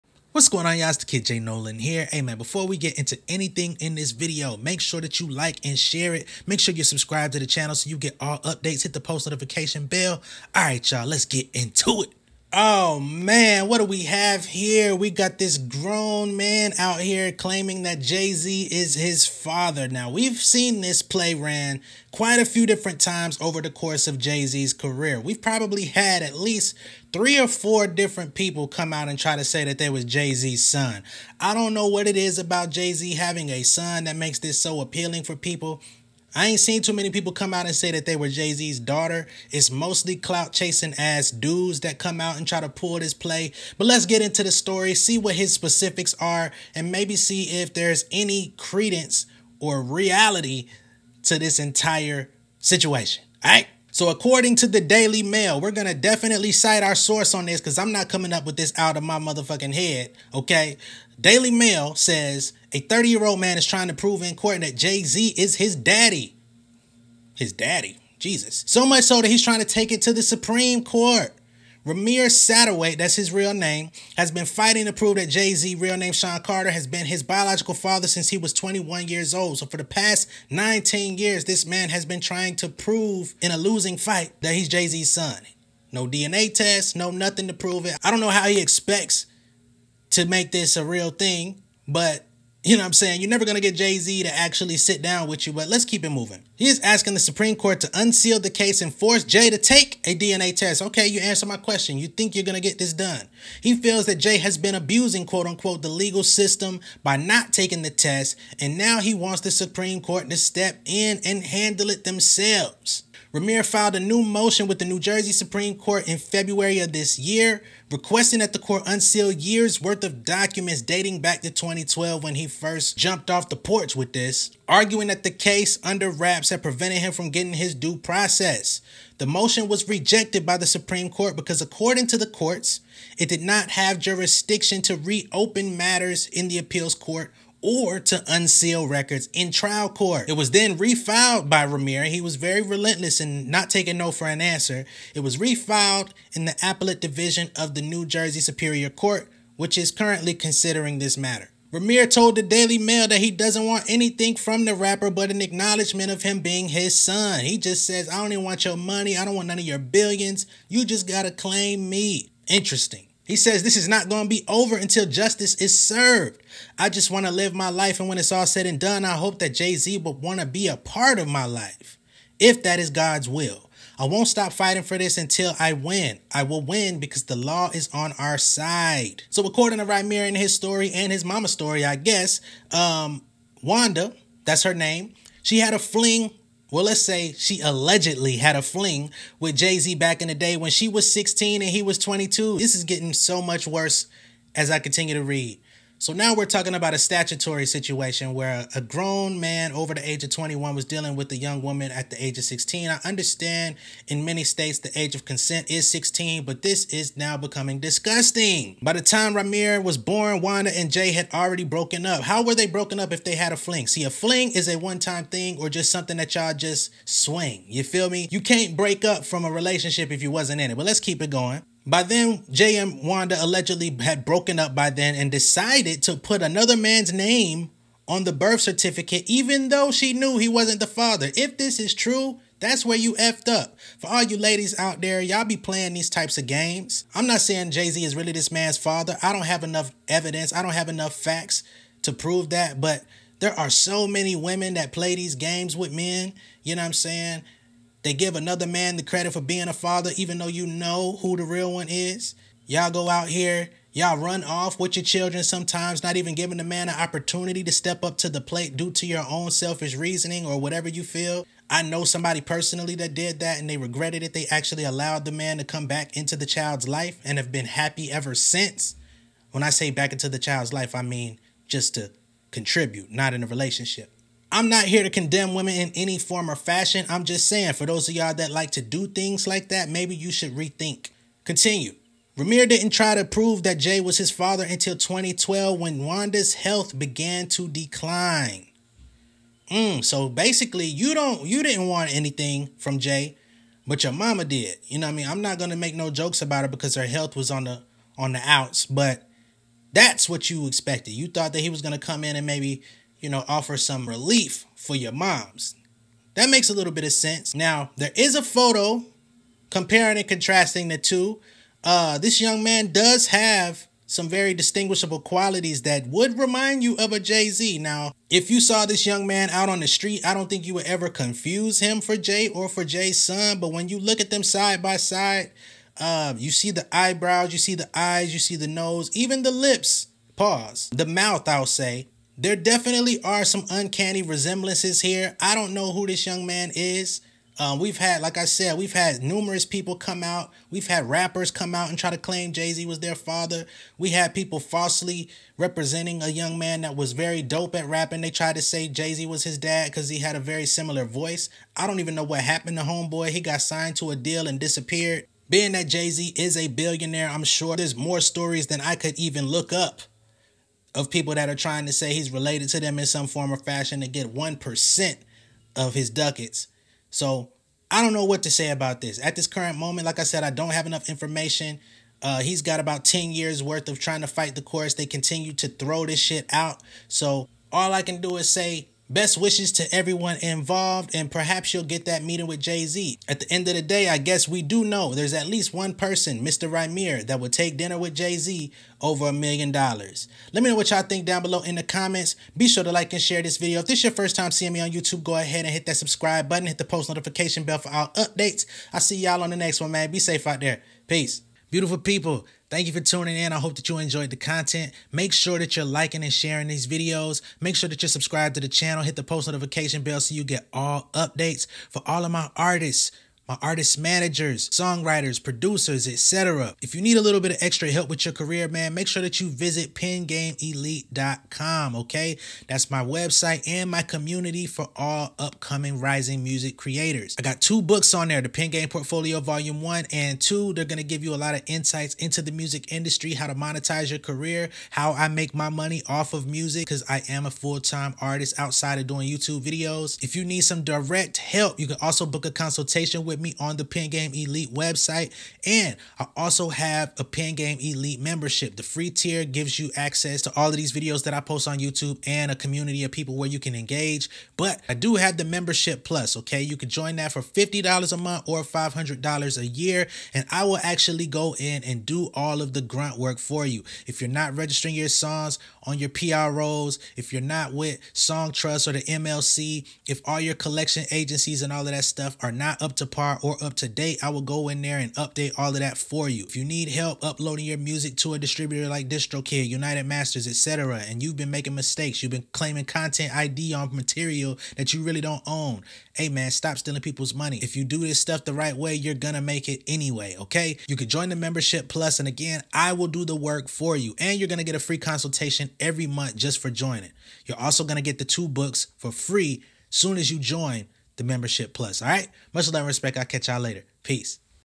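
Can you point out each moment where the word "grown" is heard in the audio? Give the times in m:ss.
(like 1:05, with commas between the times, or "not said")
0:15, 3:18.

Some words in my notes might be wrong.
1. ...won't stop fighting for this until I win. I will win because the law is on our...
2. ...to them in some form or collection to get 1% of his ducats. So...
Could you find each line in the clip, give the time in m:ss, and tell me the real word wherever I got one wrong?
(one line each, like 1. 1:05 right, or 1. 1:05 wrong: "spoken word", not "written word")
1. 2:54 right
2. 6:02 wrong: "fashion", not "collection".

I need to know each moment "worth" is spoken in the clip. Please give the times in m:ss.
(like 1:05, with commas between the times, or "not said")
1:59, 6:13.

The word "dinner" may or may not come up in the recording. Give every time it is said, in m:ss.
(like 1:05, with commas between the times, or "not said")
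6:27.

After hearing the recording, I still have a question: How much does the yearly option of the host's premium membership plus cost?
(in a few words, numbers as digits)
$500.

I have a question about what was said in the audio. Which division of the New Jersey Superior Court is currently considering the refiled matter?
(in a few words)
appellate division.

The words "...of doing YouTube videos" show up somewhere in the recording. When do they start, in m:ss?
7:18.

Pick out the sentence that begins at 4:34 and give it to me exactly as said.
I'm not here to condemn women in any form or fashion.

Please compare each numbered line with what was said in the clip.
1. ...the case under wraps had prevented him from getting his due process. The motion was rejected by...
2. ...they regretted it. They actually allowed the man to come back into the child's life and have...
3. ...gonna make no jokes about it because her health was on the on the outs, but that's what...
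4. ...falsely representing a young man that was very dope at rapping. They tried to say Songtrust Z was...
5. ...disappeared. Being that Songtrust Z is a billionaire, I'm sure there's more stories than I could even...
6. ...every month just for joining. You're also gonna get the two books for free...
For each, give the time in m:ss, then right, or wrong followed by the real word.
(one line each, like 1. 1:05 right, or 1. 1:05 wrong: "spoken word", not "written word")
1. 2:05 right
2. 4:23 right
3. 4:55 right
4. 5:44 wrong: "Jay", not "Songtrust"
5. 5:54 wrong: "Jay", not "Songtrust"
6. 8:15 right.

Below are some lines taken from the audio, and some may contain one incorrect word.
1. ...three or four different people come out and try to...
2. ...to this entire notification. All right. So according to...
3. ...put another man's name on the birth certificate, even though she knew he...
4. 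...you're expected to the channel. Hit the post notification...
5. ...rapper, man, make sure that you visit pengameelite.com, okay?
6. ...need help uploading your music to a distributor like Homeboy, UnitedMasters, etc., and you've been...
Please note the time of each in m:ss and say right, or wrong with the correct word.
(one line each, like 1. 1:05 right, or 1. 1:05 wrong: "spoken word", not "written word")
1. 0:27 right
2. 0:51 wrong: "situation", not "notification"
3. 3:46 right
4. 6:48 wrong: "subscribed", not "expected"
5. 6:58 wrong: "career", not "rapper"
6. 7:56 wrong: "DistroKid", not "Homeboy".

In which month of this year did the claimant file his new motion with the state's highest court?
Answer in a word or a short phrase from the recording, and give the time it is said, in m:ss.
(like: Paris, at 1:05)
February, at 1:56.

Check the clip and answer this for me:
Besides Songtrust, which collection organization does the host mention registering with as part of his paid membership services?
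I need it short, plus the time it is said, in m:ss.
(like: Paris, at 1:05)
the MLC, at 7:48.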